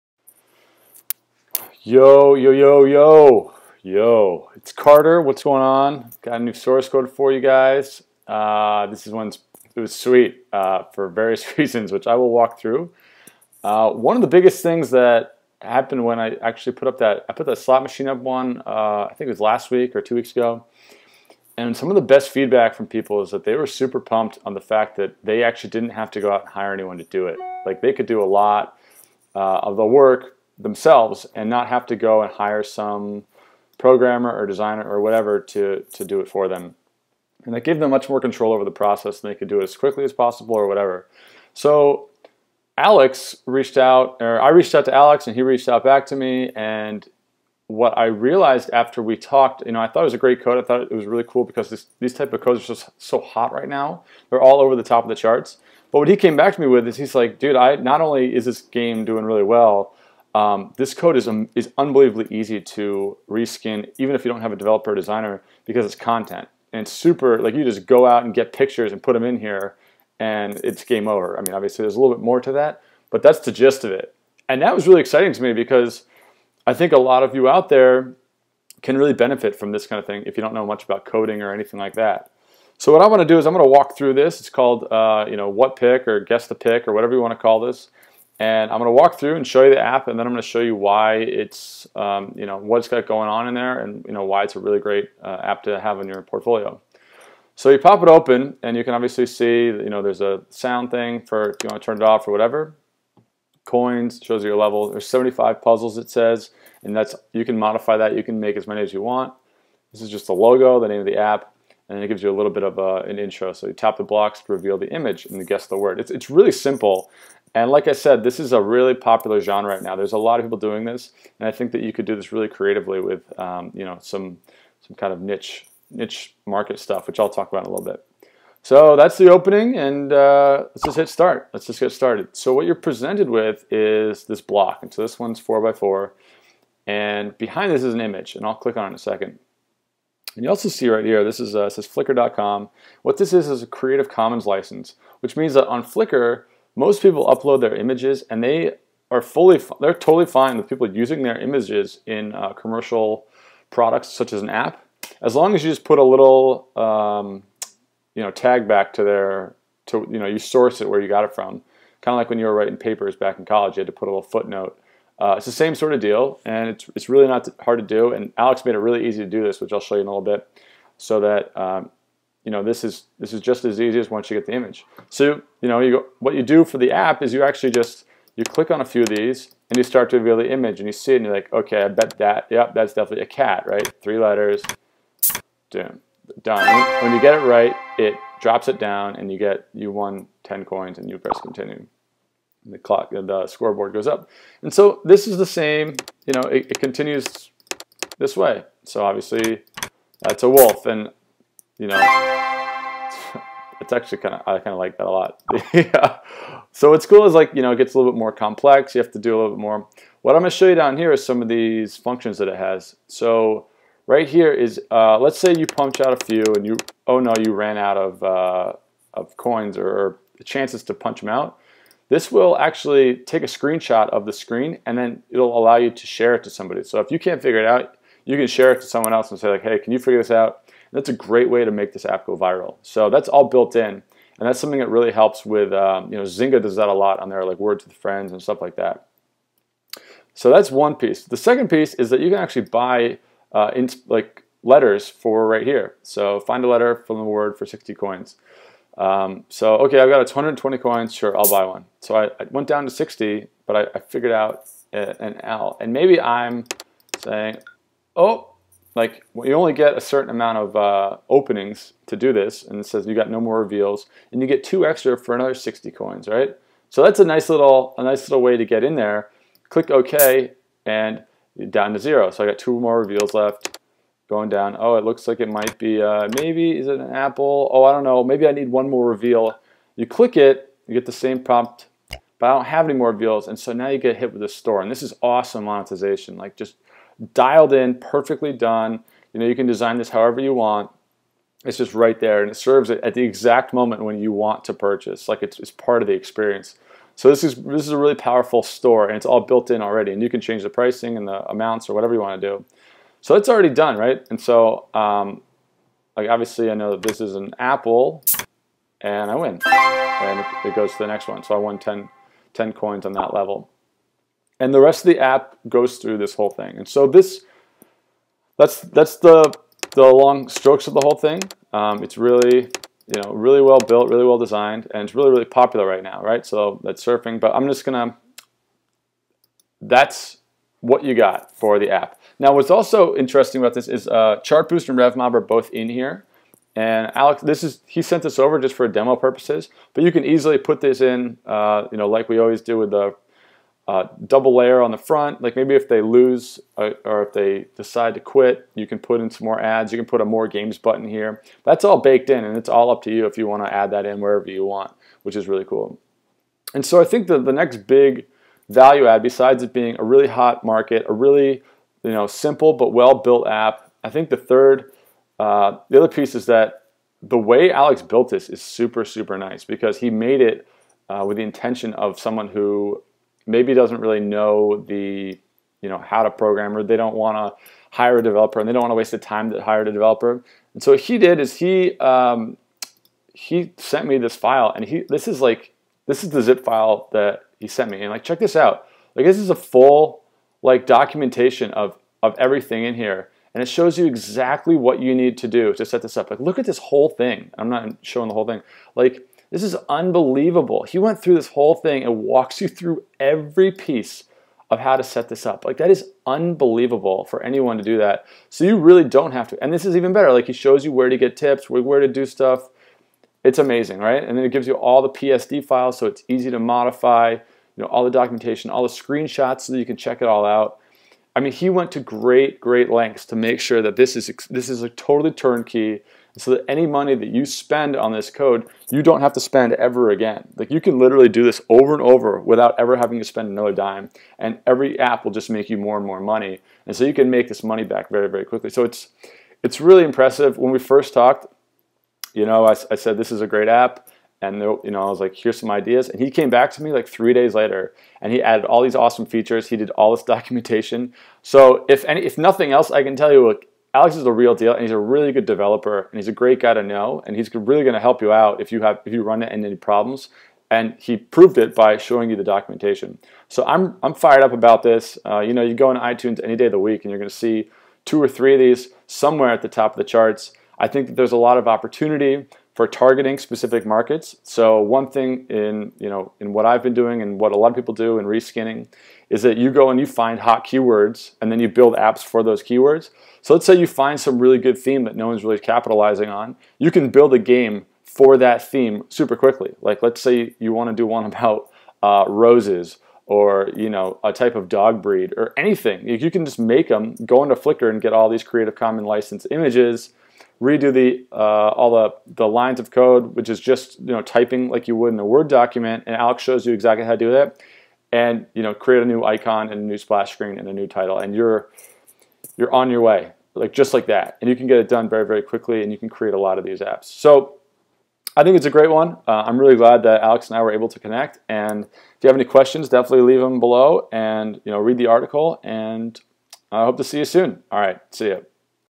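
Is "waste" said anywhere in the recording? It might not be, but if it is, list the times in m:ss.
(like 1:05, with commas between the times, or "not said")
6:18.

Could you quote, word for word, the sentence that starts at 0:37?
And that gave them much more control over the process and they could do it as quickly as possible or whatever.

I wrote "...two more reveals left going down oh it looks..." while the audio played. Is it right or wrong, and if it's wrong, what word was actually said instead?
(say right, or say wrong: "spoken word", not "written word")
right.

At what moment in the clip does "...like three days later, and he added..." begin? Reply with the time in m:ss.
7:26.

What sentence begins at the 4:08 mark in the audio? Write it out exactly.
Um, so, okay, I've got 120 coins, sure, I'll buy one.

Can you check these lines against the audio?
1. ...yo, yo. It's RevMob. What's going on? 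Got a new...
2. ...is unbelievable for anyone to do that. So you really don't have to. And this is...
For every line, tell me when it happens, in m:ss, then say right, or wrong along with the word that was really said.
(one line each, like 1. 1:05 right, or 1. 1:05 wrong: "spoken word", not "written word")
1. 0:02 wrong: "Carter", not "RevMob"
2. 6:45 right.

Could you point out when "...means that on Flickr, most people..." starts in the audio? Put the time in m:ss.
2:25.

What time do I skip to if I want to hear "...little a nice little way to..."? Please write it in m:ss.
4:27.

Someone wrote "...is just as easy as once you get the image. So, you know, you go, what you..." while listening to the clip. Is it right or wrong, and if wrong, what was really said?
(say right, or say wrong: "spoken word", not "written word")
right.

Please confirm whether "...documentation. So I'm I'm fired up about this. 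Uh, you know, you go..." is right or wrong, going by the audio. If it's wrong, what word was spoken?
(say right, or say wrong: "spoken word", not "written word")
right.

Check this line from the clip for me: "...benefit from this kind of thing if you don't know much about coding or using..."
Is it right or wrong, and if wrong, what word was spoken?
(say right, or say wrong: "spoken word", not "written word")
wrong: "anything", not "using".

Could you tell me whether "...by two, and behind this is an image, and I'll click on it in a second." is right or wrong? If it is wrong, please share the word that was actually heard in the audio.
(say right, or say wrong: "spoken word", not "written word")
wrong: "four", not "two".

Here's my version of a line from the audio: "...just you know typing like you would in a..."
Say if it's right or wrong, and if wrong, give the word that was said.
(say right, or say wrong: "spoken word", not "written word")
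right.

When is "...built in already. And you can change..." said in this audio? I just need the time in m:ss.
4:59.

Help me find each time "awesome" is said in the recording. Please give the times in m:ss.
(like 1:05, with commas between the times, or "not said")
4:45, 7:28.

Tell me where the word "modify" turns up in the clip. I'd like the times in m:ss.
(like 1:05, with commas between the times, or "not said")
1:47, 6:56.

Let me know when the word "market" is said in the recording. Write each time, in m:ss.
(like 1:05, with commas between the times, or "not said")
2:06, 6:00, 7:53.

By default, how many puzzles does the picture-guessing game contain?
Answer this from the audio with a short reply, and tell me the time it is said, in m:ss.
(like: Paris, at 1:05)
75, at 1:45.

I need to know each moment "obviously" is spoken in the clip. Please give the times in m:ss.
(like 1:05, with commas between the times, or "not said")
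1:11, 1:38, 3:19, 5:06.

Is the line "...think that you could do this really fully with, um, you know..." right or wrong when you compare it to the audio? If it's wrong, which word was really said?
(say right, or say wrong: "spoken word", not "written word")
wrong: "creatively", not "fully".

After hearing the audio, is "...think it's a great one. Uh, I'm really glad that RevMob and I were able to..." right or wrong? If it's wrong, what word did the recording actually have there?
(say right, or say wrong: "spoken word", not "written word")
wrong: "Alex", not "RevMob".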